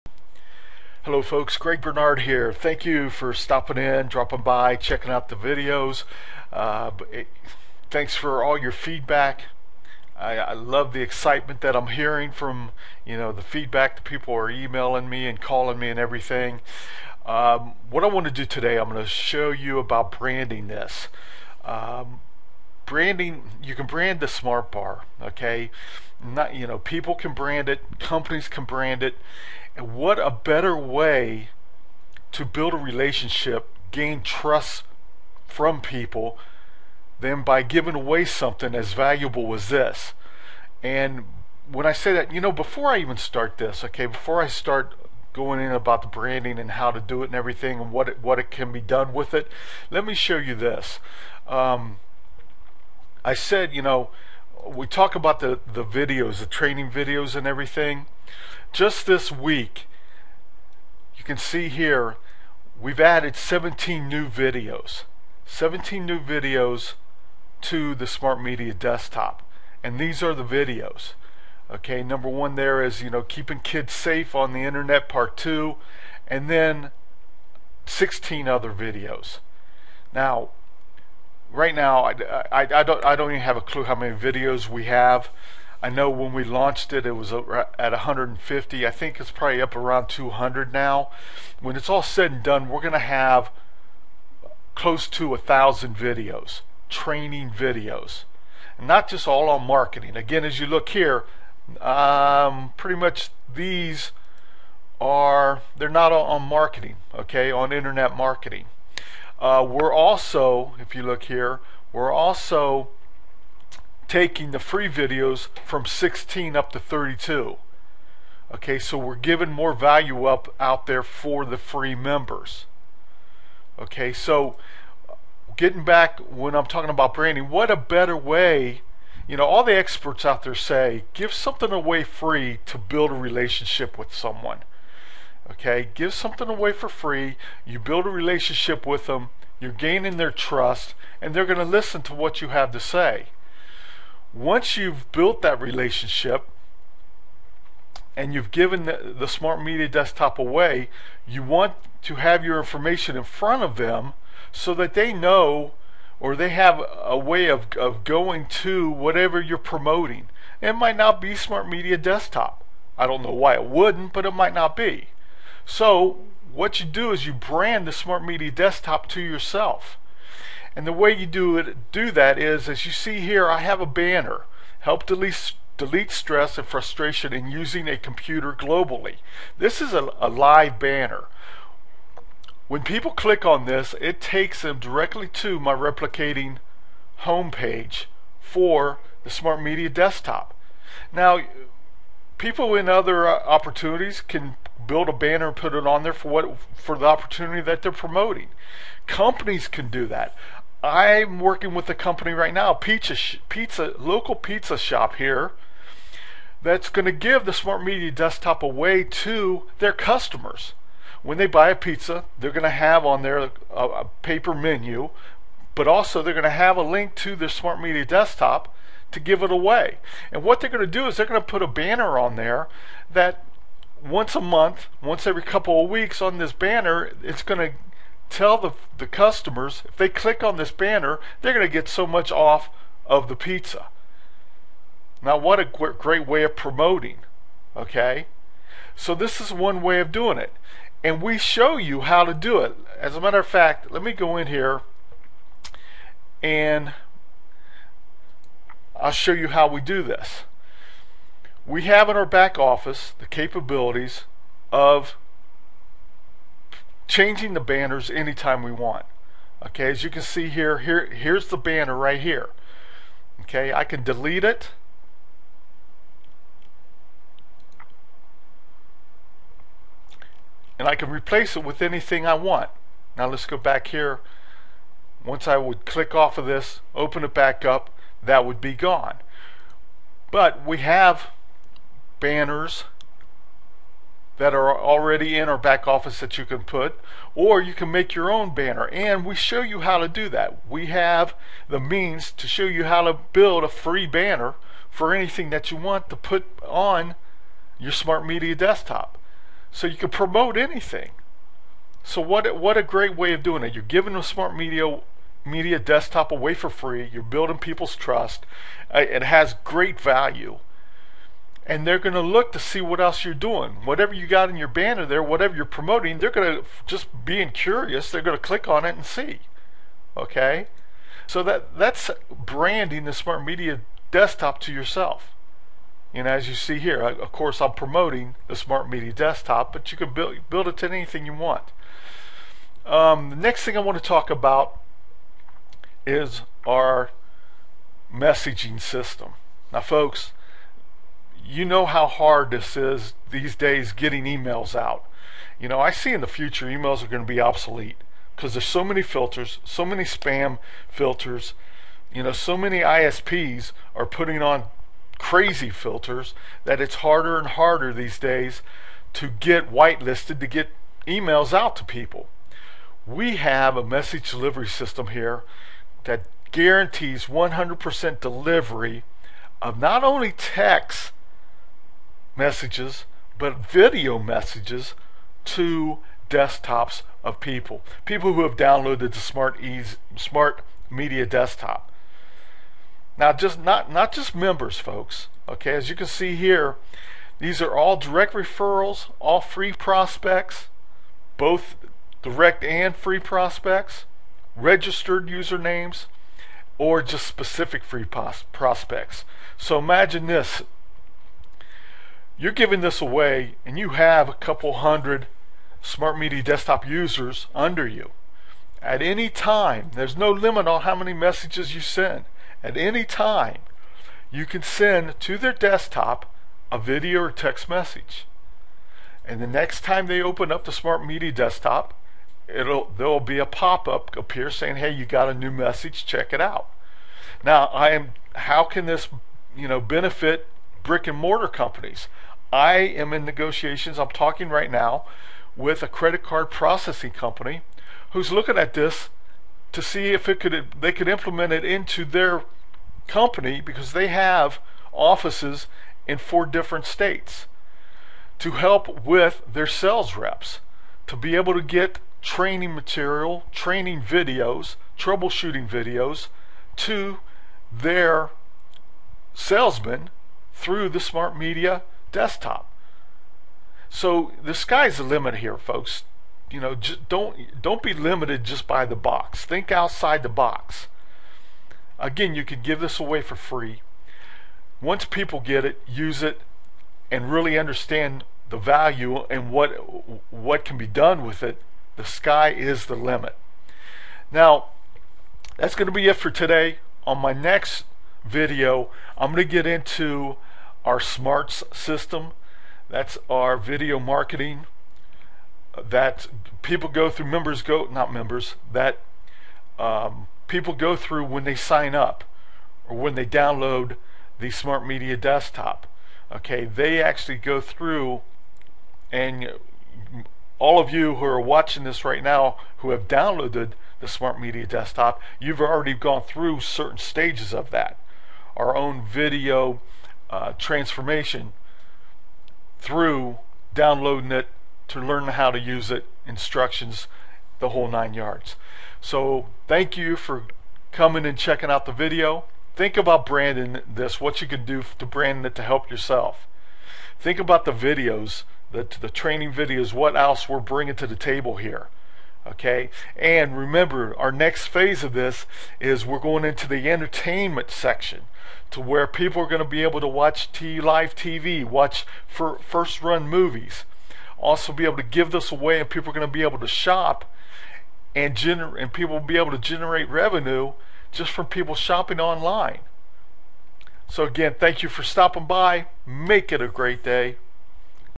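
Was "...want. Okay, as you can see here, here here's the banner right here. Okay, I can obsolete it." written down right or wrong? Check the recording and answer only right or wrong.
wrong.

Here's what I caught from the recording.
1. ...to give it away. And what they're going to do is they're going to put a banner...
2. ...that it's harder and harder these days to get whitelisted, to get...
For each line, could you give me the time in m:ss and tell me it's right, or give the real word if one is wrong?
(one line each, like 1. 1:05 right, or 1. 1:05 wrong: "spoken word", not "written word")
1. 3:39 right
2. 5:56 right.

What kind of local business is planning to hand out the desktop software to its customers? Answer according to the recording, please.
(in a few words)
pizza shop.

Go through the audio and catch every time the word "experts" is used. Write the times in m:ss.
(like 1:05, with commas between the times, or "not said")
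2:09.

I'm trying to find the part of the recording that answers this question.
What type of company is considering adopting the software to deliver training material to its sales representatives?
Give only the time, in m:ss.
7:15.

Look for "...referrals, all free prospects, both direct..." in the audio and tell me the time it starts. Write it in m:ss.
6:28.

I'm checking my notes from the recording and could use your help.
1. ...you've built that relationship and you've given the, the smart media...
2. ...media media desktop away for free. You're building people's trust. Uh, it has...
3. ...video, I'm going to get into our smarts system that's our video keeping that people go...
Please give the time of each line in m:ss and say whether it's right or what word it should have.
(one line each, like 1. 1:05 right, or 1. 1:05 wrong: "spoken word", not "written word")
1. 2:24 right
2. 5:04 right
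3. 8:08 wrong: "marketing", not "keeping".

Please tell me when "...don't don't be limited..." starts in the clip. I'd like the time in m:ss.
7:47.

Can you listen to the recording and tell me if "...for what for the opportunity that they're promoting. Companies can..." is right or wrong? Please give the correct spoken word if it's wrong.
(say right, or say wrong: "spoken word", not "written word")
right.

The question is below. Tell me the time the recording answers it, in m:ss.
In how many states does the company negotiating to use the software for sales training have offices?
7:26.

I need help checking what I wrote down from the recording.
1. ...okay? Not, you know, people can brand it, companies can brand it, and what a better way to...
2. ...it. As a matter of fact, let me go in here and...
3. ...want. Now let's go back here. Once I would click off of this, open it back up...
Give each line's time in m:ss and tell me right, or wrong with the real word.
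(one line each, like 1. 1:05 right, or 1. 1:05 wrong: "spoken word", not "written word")
1. 0:25 right
2. 4:02 right
3. 4:32 right.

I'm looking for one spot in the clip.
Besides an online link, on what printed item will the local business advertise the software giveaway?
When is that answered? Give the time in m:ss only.
3:34.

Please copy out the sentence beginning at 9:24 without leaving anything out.
So again, thank you for stopping by.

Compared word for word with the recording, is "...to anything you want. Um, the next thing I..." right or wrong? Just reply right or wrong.
right.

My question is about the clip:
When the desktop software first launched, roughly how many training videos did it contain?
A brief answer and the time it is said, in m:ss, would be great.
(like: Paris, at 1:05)
150, at 1:27.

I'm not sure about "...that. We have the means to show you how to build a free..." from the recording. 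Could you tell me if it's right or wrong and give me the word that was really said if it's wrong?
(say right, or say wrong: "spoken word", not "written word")
right.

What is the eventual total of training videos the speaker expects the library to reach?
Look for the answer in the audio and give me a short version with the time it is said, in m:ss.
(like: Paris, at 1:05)
close to a thousand, at 1:34.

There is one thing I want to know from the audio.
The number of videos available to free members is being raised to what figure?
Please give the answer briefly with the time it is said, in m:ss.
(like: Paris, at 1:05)
32, at 1:56.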